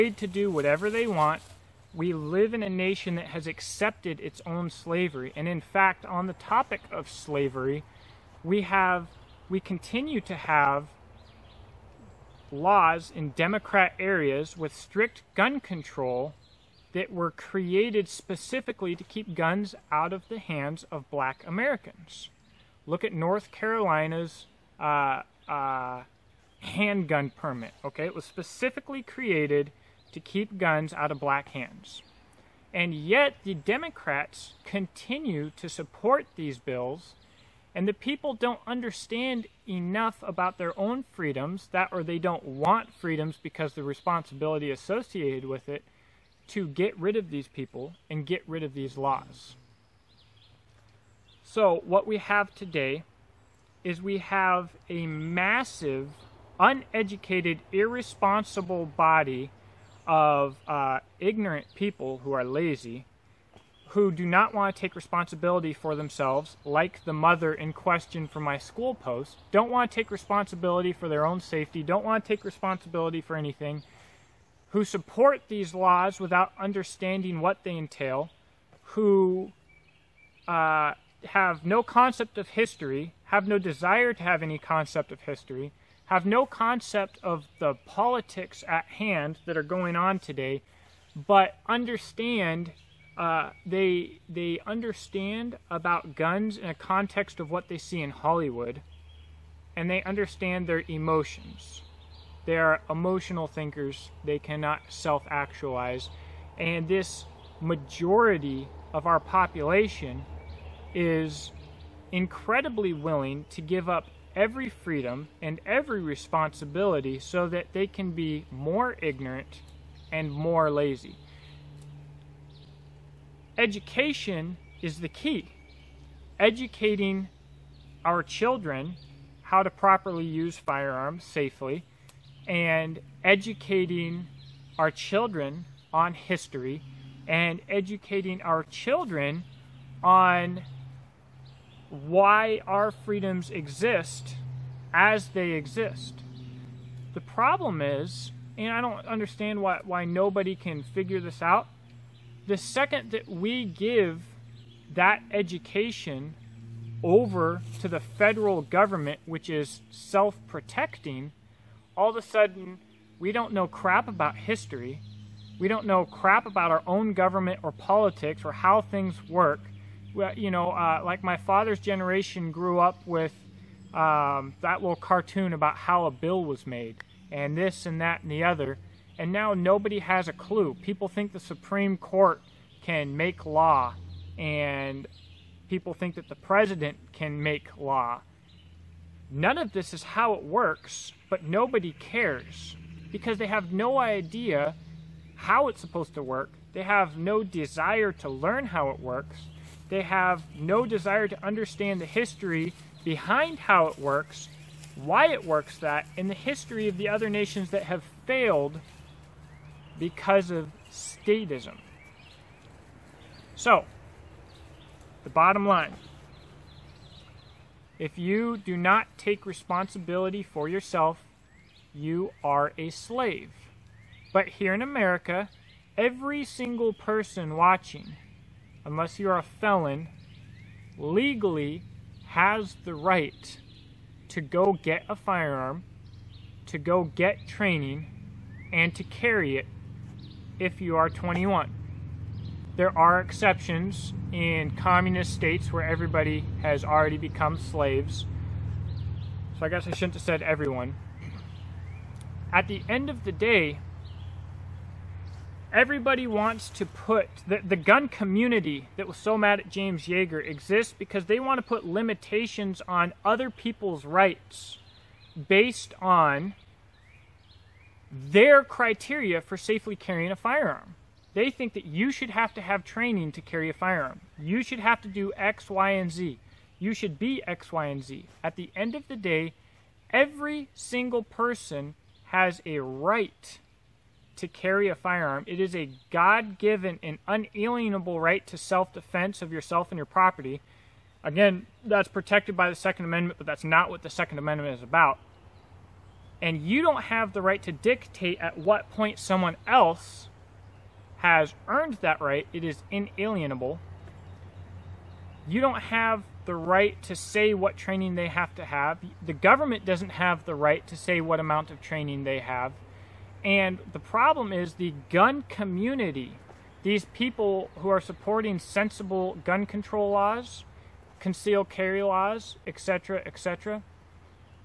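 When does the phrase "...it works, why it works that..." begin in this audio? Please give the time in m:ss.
3:23.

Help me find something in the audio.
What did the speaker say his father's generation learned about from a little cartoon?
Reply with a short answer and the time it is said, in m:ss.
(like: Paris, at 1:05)
How a bill was made, at 2:55.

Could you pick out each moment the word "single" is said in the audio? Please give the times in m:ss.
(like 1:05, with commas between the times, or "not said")
3:46, 4:40.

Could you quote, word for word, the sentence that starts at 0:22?
Look at North Carolina's uh, uh, handgun permit, okay?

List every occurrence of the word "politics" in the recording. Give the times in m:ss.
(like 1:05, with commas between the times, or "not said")
1:27, 2:47.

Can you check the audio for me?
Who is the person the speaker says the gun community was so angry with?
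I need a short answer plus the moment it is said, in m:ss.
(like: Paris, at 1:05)
James Yeager, at 4:19.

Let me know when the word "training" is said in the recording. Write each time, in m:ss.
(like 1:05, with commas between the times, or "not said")
3:57, 4:32, 5:07, 5:11.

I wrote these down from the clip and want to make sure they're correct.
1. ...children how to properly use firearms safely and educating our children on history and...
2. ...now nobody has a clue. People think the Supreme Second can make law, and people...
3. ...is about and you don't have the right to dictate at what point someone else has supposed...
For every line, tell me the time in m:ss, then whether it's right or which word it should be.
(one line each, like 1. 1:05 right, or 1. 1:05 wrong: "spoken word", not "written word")
1. 2:08 right
2. 2:59 wrong: "Court", not "Second"
3. 4:54 wrong: "earned", not "supposed".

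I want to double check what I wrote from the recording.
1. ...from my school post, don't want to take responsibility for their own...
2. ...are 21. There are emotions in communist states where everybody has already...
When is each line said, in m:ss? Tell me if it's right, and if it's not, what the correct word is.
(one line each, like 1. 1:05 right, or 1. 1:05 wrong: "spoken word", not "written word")
1. 1:08 right
2. 4:00 wrong: "exceptions", not "emotions".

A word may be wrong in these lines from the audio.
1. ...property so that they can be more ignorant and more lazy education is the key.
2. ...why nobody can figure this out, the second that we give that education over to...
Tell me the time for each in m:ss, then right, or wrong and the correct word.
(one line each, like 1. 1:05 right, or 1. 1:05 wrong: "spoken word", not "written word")
1. 1:56 wrong: "responsibility", not "property"
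2. 2:29 right.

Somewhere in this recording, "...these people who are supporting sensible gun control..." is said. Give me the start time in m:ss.
5:16.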